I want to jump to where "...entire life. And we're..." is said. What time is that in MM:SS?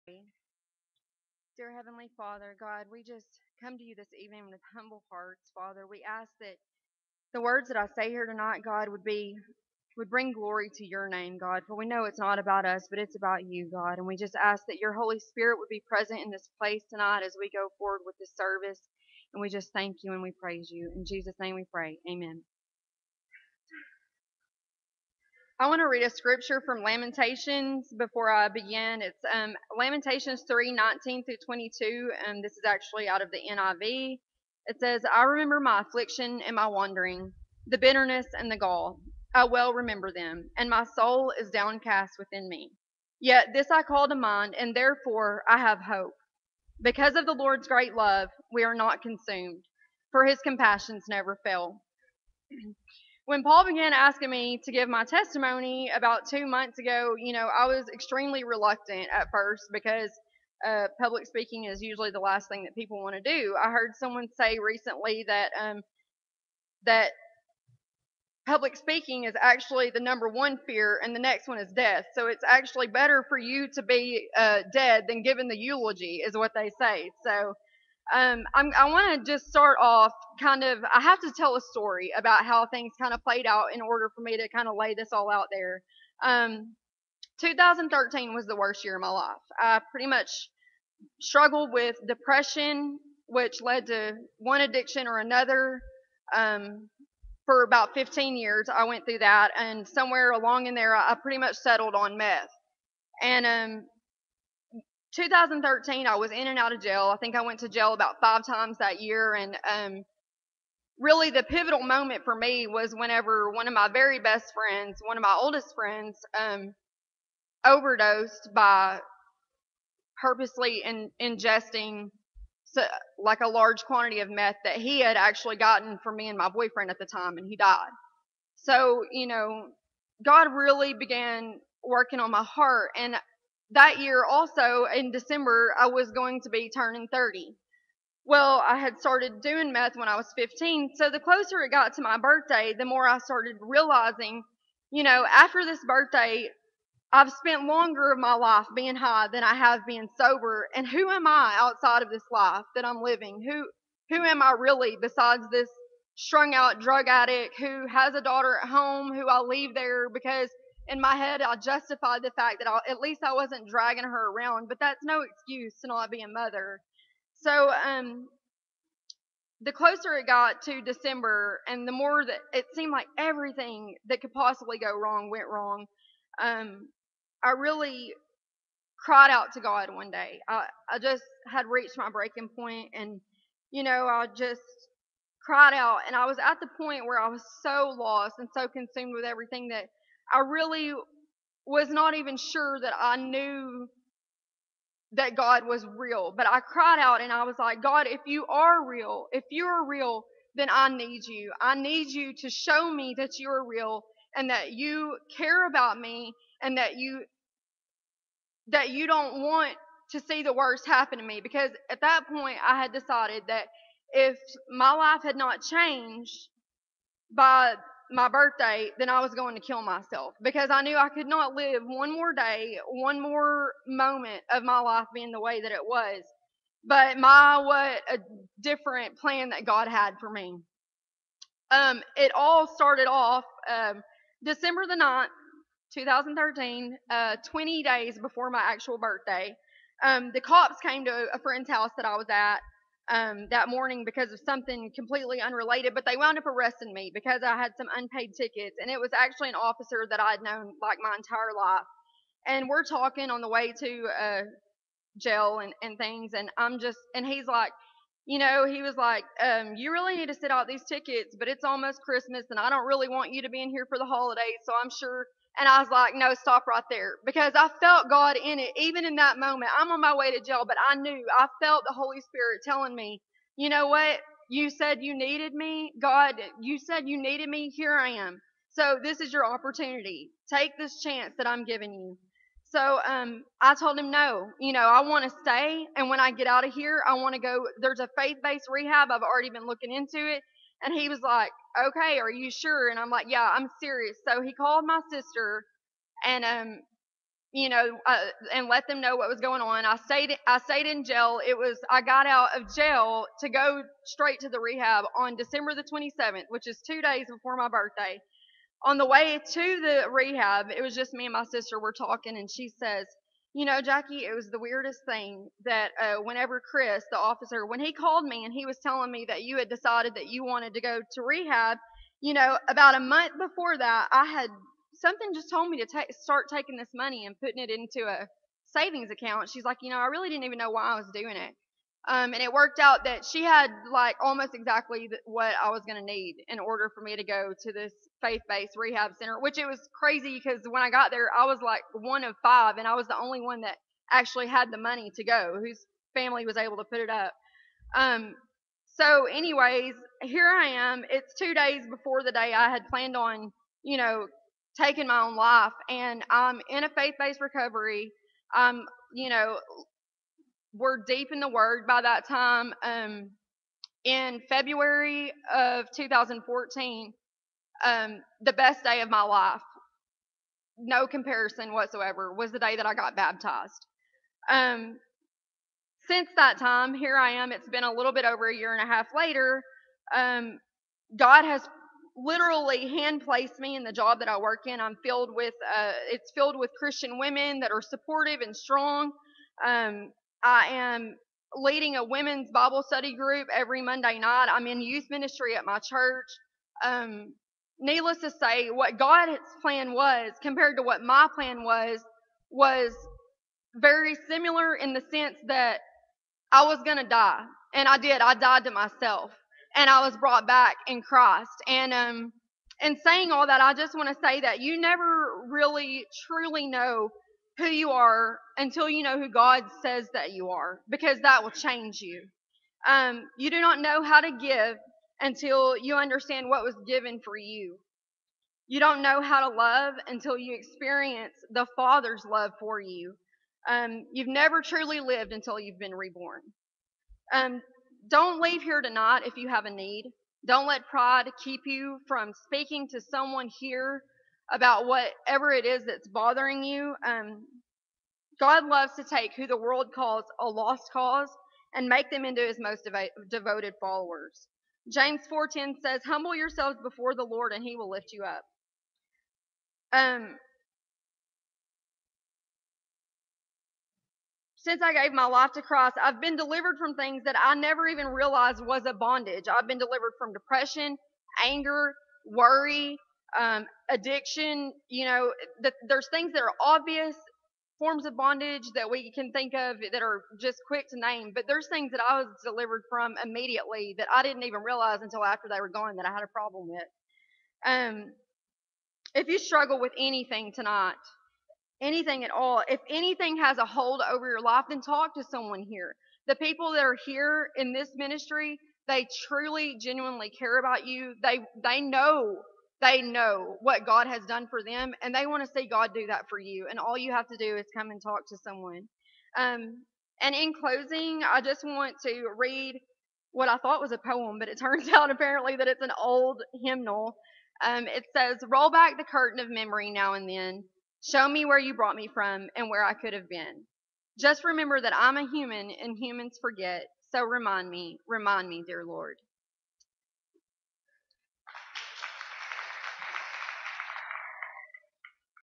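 04:11.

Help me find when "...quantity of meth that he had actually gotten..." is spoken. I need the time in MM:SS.
02:03.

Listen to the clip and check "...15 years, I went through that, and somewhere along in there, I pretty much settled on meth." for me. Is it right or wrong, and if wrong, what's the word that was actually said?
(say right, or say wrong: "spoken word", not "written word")
right.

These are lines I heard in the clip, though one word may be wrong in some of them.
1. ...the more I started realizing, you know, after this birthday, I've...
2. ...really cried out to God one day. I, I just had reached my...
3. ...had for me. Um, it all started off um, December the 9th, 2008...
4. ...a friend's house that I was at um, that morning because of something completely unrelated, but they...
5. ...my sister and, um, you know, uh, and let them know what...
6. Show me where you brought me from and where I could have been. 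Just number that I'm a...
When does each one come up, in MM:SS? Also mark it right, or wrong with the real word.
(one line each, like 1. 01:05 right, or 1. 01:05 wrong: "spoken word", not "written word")
1. 02:22 right
2. 02:57 right
3. 03:49 wrong: "2013", not "2008"
4. 04:01 right
5. 04:54 right
6. 08:41 wrong: "remember", not "number".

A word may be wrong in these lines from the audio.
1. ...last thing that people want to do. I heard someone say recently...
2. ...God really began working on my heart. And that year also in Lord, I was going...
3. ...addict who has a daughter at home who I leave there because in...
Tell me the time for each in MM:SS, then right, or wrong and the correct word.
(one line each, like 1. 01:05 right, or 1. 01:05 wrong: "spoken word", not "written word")
1. 01:02 right
2. 02:10 wrong: "December", not "Lord"
3. 02:37 right.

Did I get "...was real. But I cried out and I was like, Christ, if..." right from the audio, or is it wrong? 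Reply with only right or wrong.
wrong.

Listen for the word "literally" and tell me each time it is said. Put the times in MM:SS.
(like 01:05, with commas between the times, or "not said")
06:22.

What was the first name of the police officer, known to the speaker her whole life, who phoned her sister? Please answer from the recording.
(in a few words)
Chris.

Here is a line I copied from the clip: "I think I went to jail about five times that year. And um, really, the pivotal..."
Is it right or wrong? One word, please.
right.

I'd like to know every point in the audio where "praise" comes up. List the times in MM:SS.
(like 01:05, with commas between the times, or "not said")
00:20.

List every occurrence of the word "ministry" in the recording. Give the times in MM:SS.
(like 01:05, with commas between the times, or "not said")
06:35, 08:17.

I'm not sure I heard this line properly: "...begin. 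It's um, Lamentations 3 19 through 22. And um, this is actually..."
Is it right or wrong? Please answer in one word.
right.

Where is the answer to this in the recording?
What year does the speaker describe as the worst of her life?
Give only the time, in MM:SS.
01:27.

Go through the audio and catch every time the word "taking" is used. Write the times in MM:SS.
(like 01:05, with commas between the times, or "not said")
05:26, 05:54.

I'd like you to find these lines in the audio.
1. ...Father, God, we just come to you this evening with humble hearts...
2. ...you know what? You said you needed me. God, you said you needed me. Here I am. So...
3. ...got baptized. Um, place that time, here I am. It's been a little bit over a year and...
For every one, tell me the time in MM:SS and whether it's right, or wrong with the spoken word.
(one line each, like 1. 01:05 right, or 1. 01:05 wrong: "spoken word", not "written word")
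1. 00:02 right
2. 04:33 right
3. 06:12 wrong: "since", not "place".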